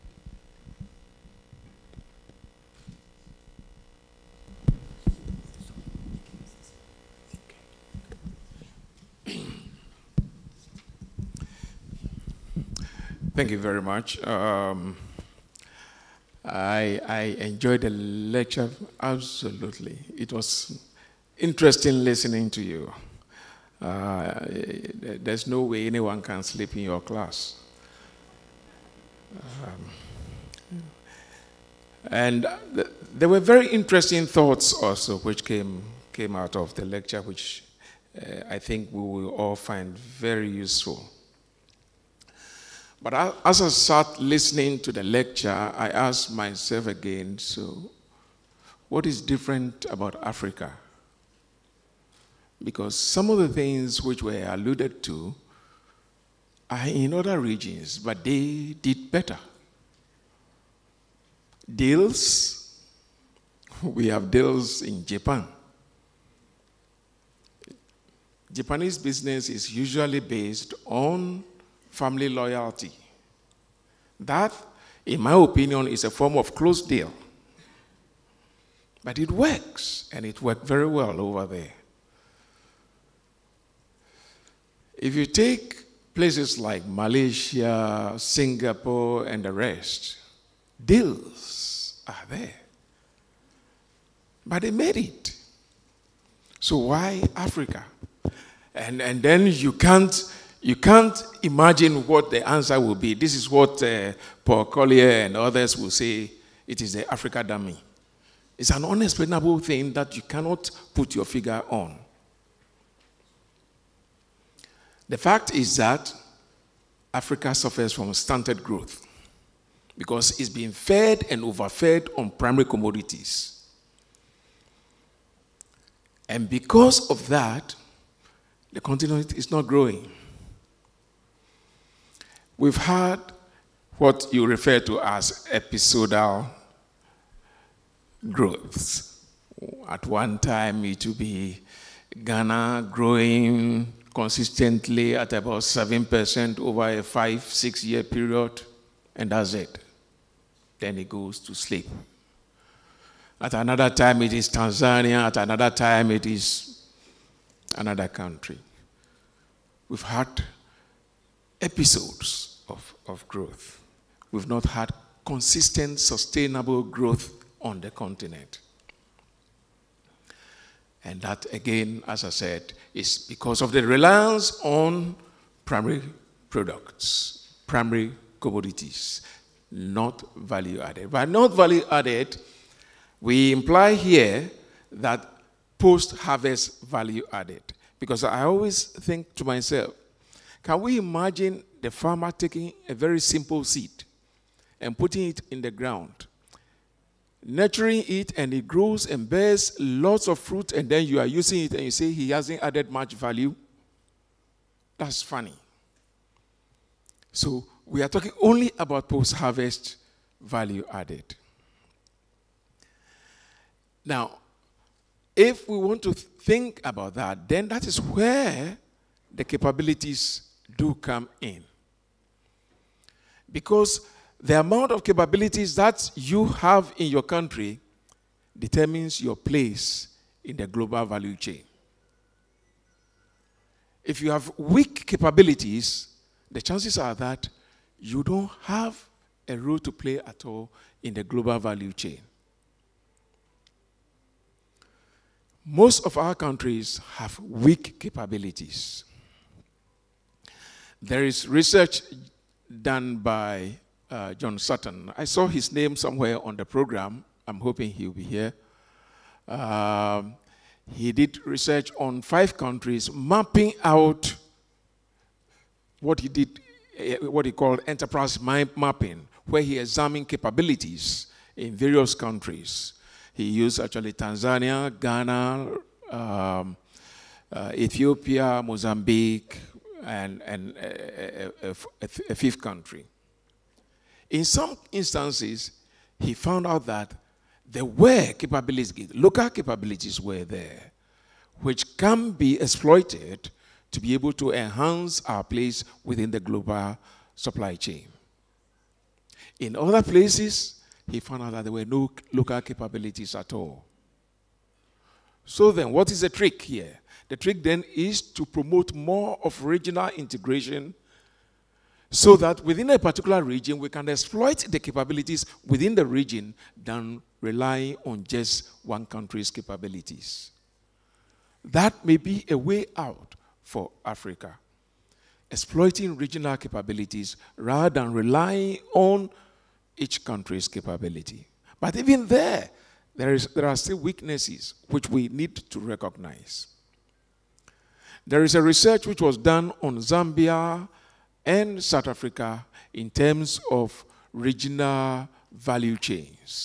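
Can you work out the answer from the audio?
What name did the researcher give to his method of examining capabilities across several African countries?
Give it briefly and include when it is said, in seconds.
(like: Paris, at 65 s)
enterprise mapping, at 267 s.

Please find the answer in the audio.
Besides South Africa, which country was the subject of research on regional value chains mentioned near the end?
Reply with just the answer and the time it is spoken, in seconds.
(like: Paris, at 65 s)
Zambia, at 339 s.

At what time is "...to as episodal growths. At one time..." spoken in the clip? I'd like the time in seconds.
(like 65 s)
134 s.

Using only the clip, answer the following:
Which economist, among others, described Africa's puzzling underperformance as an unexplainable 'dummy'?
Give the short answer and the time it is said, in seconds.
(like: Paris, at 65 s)
Paul Collier, at 104 s.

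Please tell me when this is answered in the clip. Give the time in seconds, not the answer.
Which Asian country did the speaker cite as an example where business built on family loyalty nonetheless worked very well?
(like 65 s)
65 s.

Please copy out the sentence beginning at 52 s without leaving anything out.
Because some of the things which were alluded to are in other regions, but they did better.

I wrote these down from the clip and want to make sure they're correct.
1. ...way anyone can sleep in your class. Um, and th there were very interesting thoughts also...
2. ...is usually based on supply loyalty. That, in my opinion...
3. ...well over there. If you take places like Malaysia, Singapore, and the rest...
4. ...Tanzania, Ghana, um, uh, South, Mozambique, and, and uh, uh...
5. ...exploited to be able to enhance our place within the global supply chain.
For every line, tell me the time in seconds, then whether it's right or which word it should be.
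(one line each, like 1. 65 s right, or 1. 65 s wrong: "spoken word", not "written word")
1. 25 s right
2. 69 s wrong: "family", not "supply"
3. 80 s right
4. 274 s wrong: "Ethiopia", not "South"
5. 292 s right.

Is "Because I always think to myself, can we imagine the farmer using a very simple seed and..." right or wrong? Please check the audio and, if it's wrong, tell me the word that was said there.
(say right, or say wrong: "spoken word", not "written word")
wrong: "taking", not "using".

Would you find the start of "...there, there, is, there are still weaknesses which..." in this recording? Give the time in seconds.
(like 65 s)
332 s.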